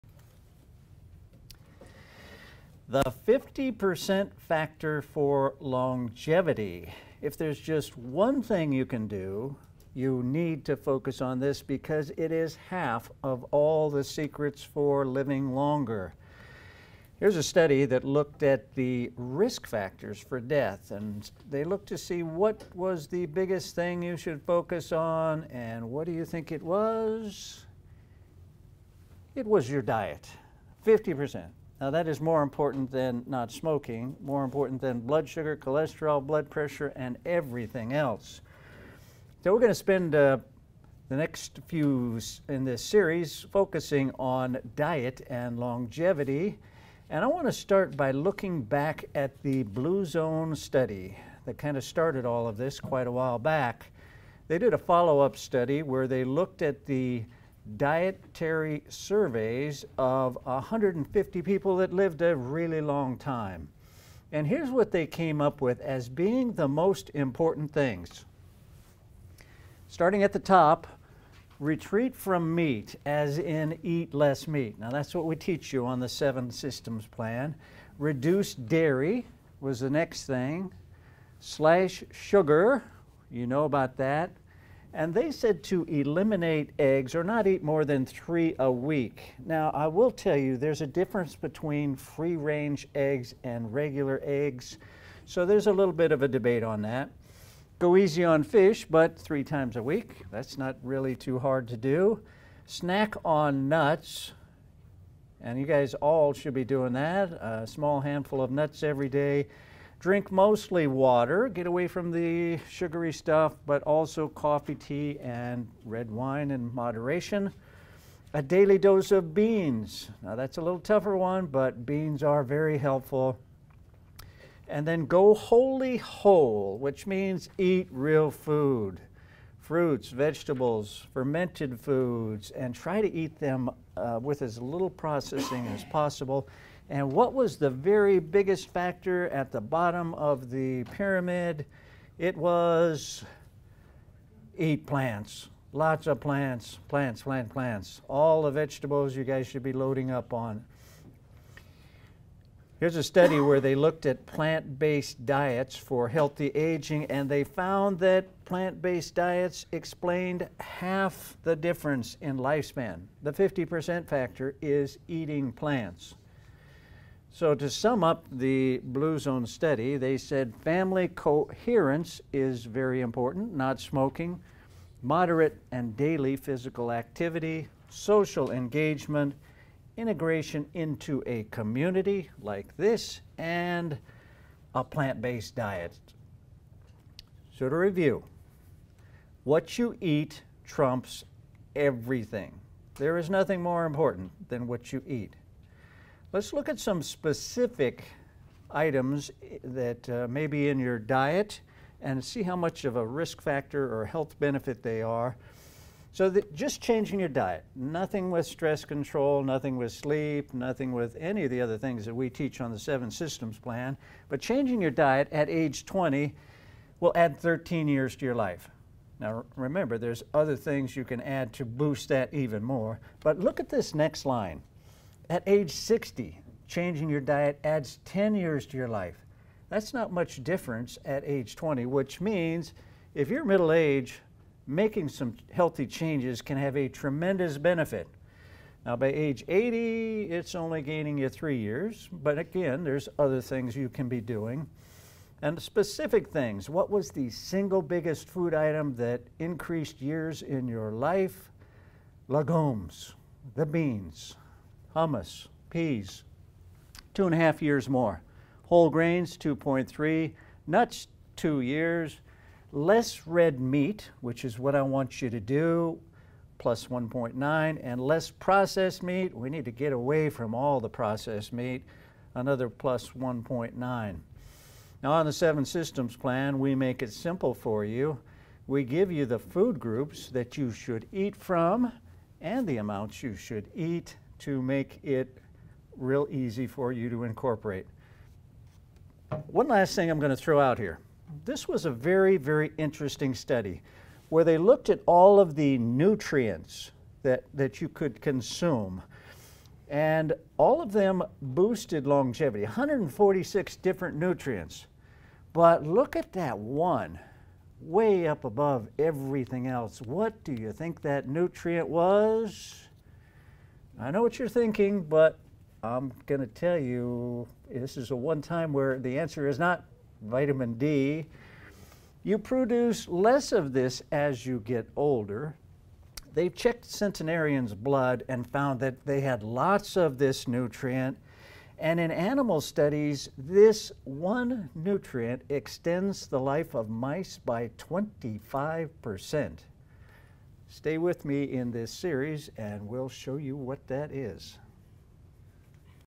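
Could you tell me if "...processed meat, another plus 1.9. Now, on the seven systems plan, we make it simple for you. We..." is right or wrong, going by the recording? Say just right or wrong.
right.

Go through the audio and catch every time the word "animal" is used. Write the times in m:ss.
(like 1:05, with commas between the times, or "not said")
5:32.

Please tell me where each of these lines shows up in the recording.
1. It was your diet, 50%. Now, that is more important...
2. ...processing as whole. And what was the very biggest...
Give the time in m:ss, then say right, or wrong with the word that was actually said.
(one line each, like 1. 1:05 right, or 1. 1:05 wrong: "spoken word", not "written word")
1. 0:29 right
2. 2:14 wrong: "possible", not "whole".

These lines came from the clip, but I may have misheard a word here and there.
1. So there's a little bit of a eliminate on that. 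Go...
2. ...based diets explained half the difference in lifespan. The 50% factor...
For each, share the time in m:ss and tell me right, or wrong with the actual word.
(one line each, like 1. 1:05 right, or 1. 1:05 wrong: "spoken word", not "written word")
1. 1:35 wrong: "debate", not "eliminate"
2. 2:38 right.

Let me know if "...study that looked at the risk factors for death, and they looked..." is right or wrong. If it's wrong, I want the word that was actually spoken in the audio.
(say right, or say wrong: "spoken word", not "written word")
right.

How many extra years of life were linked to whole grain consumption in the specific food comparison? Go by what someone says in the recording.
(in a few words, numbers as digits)
2.3.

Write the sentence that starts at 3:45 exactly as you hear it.
At age 60, changing your diet adds 10 years to your life.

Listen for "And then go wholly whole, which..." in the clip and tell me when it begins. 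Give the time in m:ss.
2:04.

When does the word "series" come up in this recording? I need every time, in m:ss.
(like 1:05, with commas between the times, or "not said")
0:42, 5:41.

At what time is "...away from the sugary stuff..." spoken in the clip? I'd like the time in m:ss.
1:51.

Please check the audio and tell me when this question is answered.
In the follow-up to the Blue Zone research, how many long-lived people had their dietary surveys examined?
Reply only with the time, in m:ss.
1:00.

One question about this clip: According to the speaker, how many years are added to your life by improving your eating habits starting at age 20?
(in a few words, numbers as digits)
13.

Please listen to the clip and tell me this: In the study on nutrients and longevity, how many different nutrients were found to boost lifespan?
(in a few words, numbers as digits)
146.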